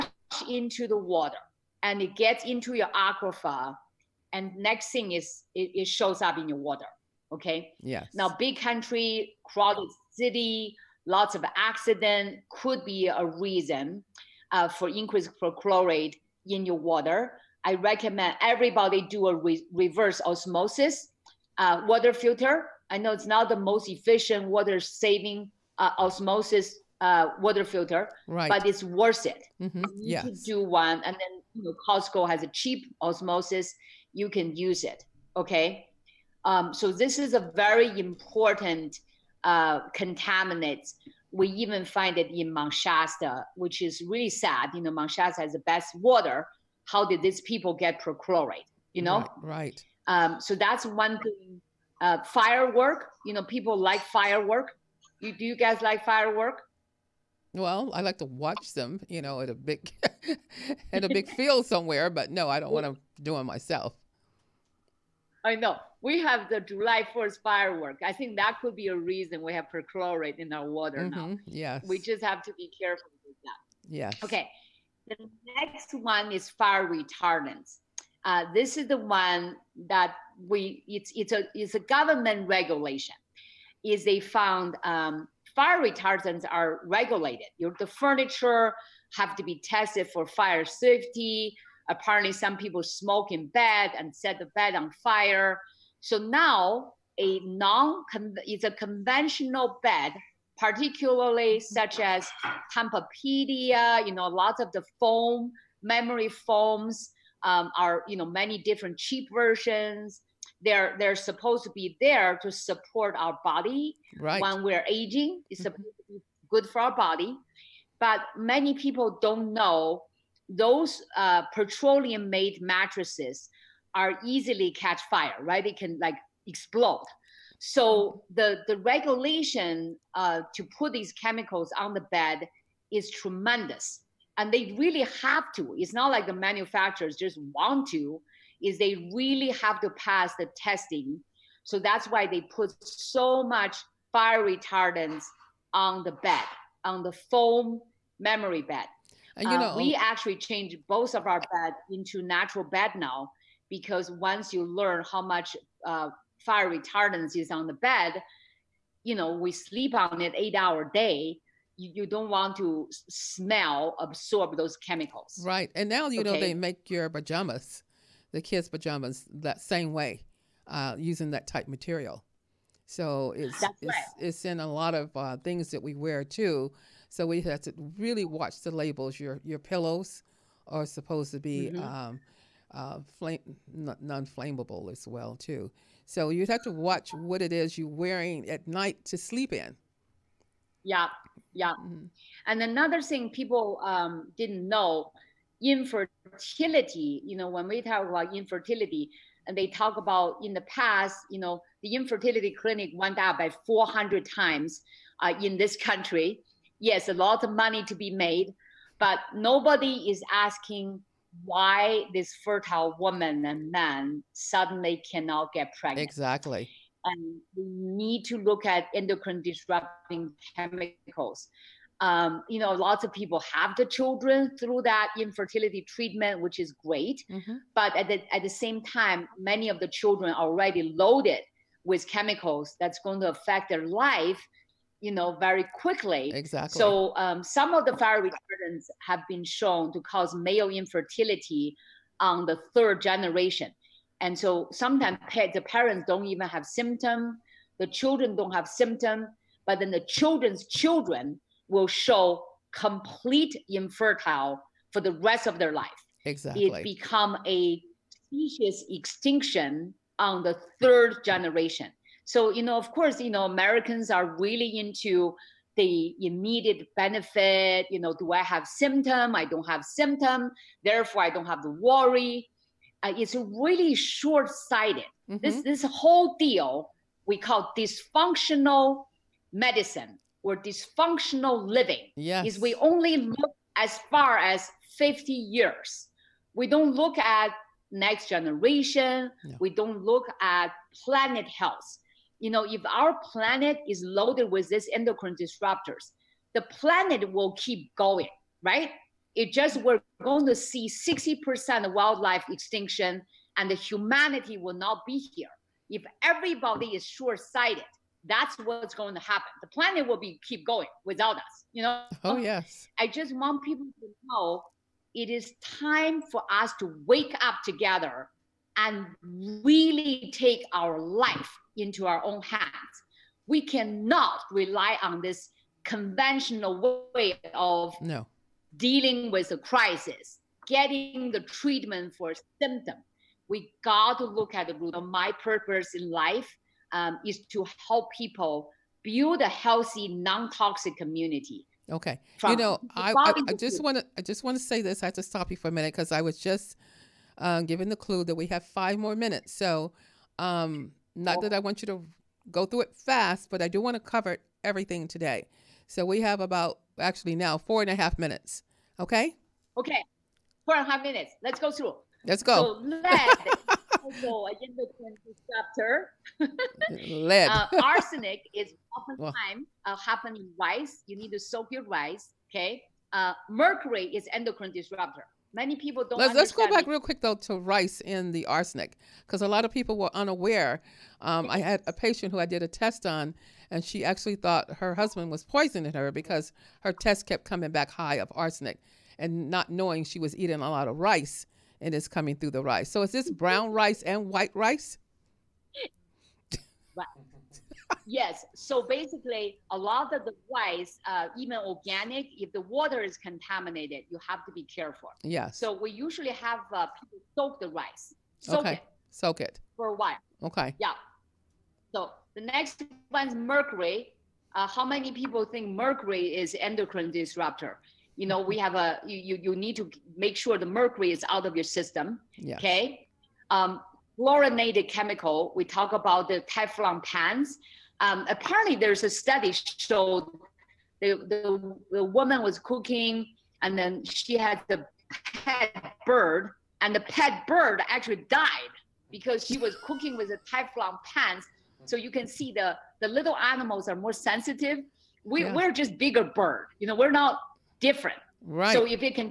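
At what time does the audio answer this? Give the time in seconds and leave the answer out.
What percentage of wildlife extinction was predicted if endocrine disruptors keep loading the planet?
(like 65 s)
300 s.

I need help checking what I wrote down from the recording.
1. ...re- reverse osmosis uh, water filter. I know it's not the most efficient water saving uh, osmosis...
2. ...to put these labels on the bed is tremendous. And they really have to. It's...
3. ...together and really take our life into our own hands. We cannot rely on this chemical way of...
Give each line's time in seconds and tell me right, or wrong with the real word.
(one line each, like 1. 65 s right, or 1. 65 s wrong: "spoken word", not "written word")
1. 19 s right
2. 130 s wrong: "chemicals", not "labels"
3. 317 s wrong: "conventional", not "chemical".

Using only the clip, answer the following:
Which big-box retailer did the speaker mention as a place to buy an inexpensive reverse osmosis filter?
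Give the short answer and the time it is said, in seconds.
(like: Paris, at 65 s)
Costco, at 31 s.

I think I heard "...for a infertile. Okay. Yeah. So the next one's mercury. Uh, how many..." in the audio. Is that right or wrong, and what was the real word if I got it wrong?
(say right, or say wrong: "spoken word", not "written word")
wrong: "while", not "infertile".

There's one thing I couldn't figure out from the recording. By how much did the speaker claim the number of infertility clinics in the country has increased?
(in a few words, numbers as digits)
400.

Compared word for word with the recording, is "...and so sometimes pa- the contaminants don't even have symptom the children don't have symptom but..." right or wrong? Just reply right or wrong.
wrong.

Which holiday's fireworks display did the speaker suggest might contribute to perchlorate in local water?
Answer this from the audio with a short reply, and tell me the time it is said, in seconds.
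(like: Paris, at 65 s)
July 4th, at 66 s.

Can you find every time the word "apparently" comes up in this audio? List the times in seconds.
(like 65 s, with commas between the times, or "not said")
91 s, 428 s.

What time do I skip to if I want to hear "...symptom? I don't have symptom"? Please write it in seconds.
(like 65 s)
268 s.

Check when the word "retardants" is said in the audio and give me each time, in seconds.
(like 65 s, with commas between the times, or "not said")
76 s, 85 s, 144 s, 156 s, 238 s.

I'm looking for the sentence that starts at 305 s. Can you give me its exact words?
If everybody is short-sighted, that's what's going to happen.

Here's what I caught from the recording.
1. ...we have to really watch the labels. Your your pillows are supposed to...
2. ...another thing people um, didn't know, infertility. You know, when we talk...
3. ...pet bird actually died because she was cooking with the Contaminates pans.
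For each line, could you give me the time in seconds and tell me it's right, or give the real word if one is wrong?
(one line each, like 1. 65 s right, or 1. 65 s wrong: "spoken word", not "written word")
1. 177 s right
2. 192 s right
3. 437 s wrong: "Teflon", not "Contaminates".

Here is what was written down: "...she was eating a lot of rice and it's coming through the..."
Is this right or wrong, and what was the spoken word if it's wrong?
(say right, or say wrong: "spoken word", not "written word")
right.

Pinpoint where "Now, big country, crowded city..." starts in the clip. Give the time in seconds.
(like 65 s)
8 s.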